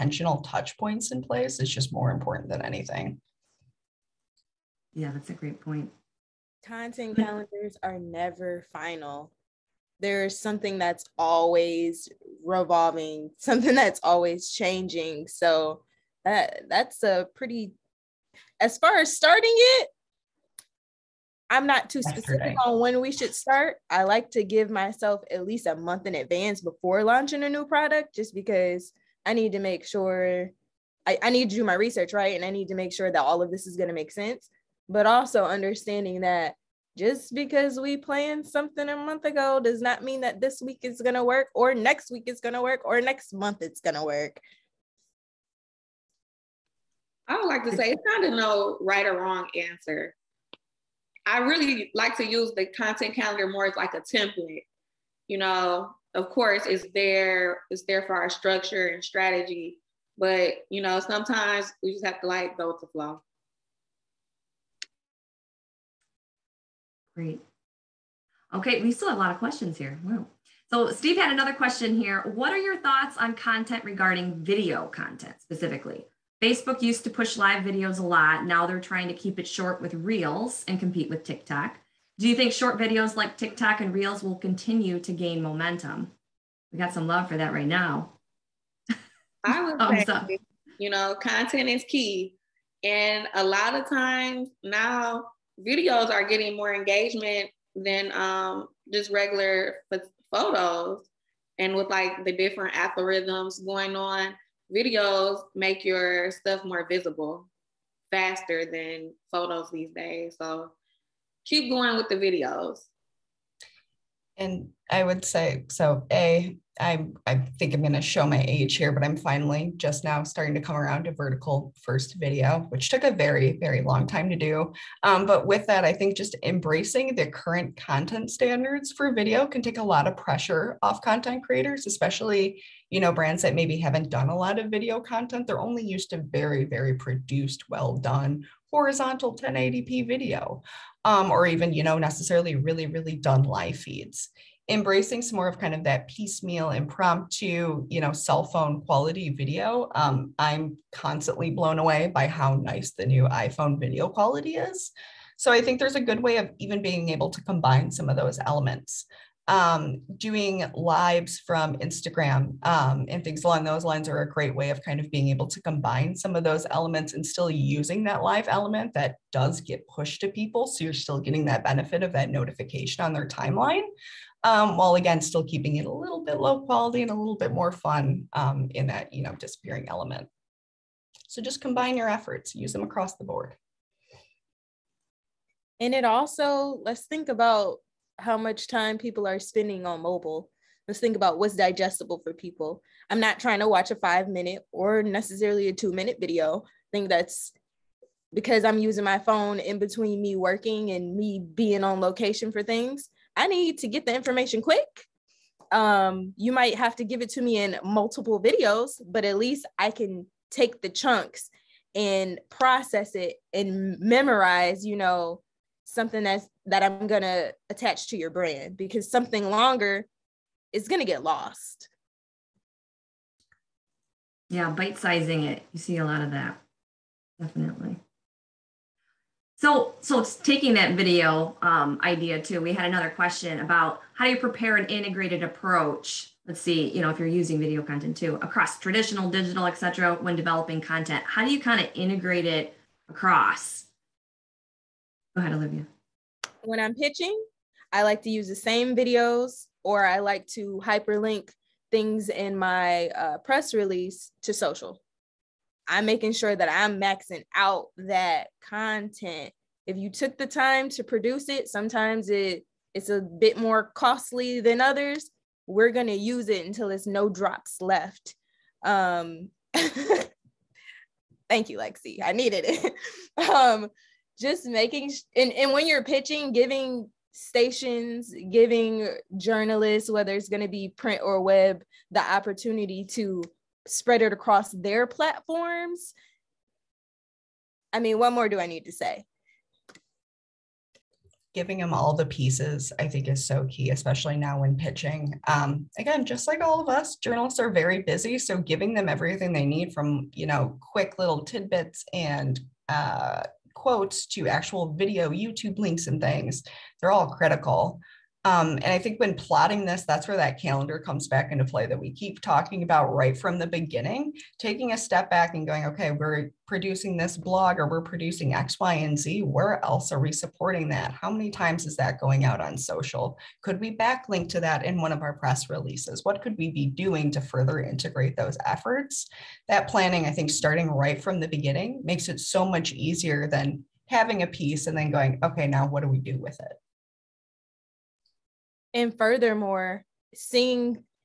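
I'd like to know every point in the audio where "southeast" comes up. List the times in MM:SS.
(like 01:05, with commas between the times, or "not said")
not said.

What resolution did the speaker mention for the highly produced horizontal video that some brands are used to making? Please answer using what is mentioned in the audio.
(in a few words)
1080p.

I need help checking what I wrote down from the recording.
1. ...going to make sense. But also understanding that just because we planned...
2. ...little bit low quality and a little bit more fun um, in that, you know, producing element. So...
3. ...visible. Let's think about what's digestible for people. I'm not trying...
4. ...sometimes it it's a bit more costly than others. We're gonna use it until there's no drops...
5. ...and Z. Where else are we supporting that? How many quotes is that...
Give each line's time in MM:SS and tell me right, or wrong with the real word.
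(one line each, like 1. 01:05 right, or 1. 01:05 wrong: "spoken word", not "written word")
1. 00:33 right
2. 02:55 wrong: "disappearing", not "producing"
3. 03:10 wrong: "mobile", not "visible"
4. 04:21 right
5. 05:18 wrong: "times", not "quotes".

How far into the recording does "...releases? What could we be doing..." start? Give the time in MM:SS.
05:25.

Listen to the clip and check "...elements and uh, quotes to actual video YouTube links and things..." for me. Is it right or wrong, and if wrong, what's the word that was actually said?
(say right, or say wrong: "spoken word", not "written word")
wrong: "tidbits", not "elements".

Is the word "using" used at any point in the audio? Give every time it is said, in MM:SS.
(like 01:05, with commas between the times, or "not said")
02:47, 03:18, 03:57.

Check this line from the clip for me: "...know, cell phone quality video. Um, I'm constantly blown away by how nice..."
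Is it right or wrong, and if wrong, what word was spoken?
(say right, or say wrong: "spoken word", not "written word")
right.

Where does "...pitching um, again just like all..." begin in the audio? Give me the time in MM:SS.
04:54.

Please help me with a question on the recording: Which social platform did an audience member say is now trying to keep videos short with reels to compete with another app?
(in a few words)
Facebook.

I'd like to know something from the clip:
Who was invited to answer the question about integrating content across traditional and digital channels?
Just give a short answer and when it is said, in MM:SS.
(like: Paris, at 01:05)
Olivia, at 04:05.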